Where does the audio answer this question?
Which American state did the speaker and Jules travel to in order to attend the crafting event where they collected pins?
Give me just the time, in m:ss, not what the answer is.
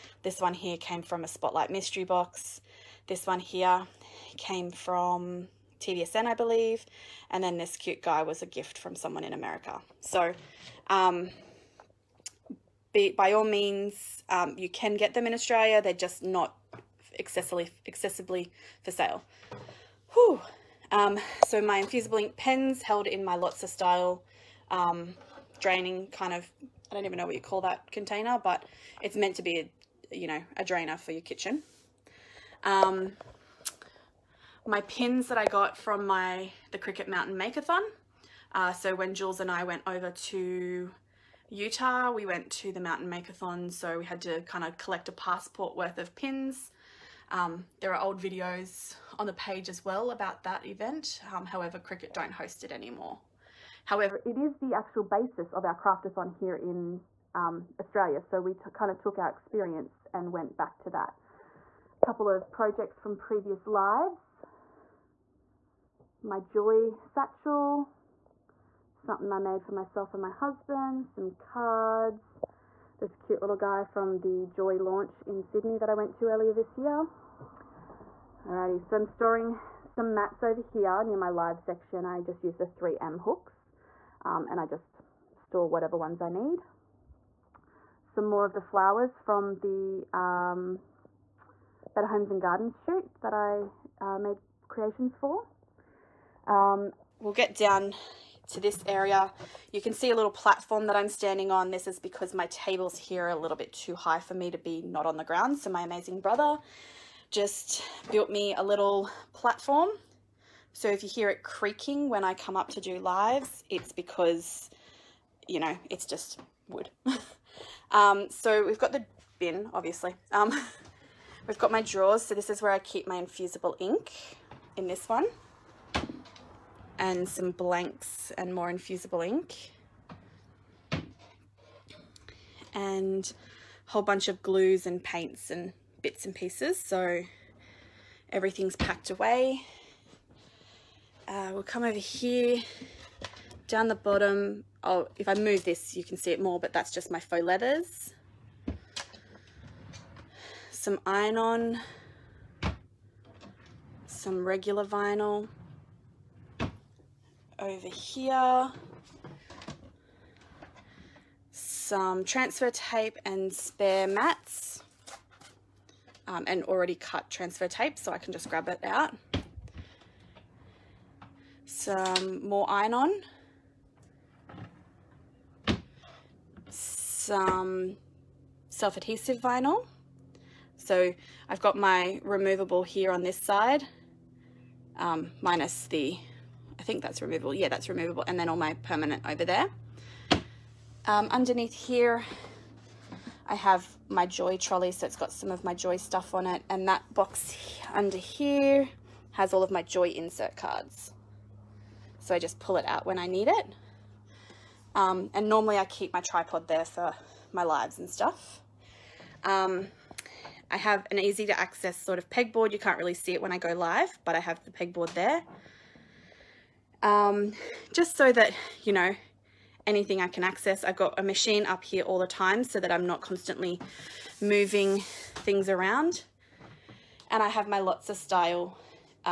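0:41.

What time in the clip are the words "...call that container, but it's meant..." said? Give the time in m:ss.
0:27.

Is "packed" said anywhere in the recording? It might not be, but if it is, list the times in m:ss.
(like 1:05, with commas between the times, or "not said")
2:18.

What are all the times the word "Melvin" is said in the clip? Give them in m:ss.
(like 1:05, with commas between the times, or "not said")
not said.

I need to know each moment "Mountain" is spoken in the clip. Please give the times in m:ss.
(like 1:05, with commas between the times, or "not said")
0:37, 0:42.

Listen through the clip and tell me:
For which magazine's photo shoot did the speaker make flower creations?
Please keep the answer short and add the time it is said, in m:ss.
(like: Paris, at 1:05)
Better Homes and Gardens, at 1:31.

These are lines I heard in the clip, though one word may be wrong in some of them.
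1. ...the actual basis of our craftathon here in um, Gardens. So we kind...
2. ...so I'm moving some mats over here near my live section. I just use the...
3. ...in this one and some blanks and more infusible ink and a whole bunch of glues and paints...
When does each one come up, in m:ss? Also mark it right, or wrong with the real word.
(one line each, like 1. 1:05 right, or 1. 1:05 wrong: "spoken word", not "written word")
1. 0:54 wrong: "Australia", not "Gardens"
2. 1:18 wrong: "storing", not "moving"
3. 2:04 right.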